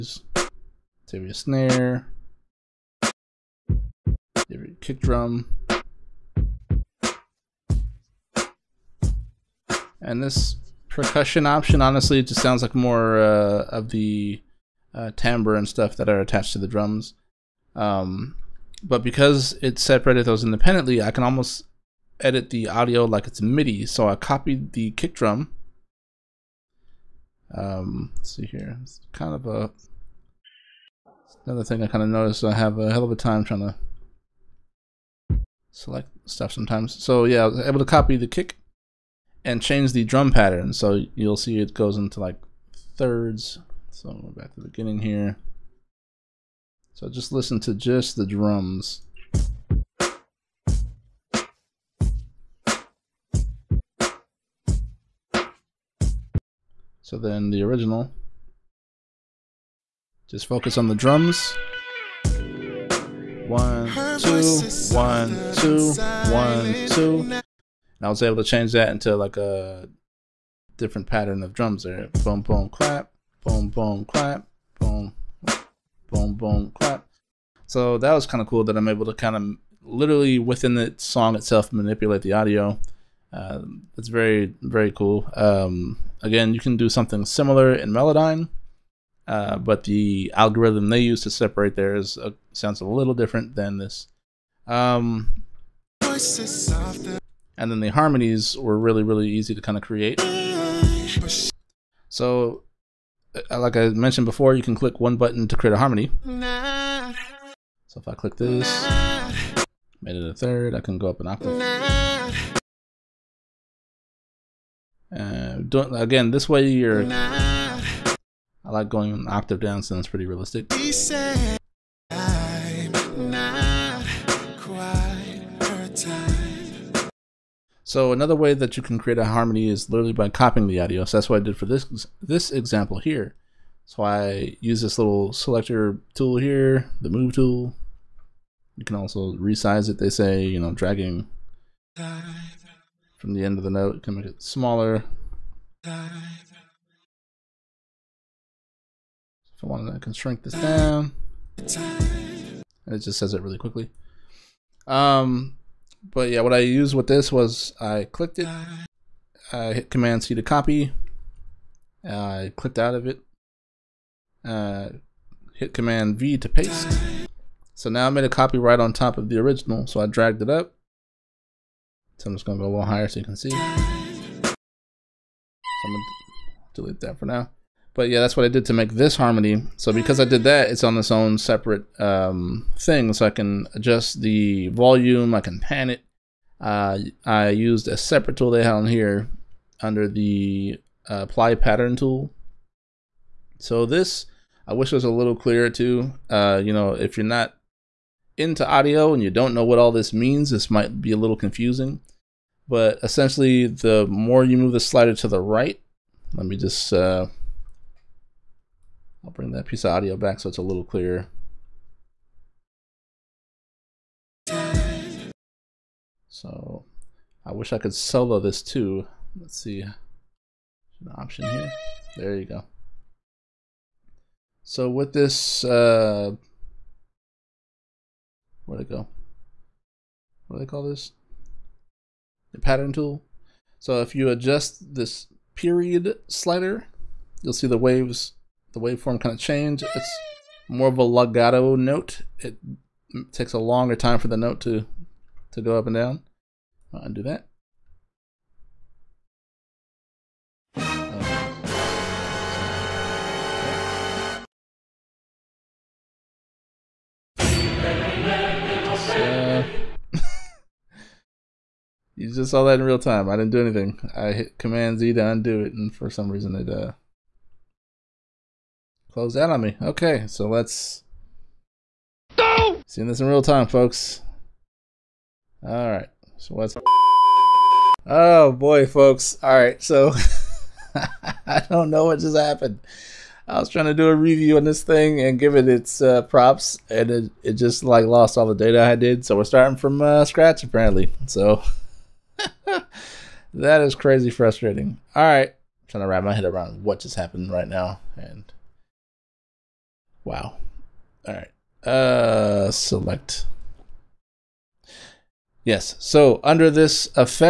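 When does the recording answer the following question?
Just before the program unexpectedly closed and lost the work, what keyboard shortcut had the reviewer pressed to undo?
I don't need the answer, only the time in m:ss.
4:24.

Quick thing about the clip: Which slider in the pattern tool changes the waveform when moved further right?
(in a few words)
period slider.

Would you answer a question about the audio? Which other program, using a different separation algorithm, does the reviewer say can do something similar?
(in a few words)
Melodyne.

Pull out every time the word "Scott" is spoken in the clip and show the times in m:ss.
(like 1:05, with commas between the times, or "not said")
not said.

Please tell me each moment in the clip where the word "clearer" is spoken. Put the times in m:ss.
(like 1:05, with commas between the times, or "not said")
3:15, 3:30.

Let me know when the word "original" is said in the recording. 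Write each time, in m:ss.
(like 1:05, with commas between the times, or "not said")
0:57, 2:49.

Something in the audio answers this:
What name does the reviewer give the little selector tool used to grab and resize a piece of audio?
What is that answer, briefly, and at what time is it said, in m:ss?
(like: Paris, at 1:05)
move tool, at 2:17.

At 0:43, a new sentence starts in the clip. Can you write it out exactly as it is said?
So back to the beginning here.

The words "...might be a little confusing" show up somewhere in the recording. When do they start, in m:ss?
3:20.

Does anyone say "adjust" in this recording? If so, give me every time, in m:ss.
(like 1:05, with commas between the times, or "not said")
3:03, 3:54.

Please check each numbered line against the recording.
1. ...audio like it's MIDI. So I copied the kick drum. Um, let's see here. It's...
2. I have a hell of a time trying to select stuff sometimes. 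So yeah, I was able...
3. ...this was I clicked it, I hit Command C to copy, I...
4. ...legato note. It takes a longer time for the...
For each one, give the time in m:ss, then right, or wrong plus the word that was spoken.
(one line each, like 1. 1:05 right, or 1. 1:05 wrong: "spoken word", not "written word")
1. 0:22 right
2. 0:32 right
3. 2:37 right
4. 4:01 right.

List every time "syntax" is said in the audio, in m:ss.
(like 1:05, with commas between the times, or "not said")
not said.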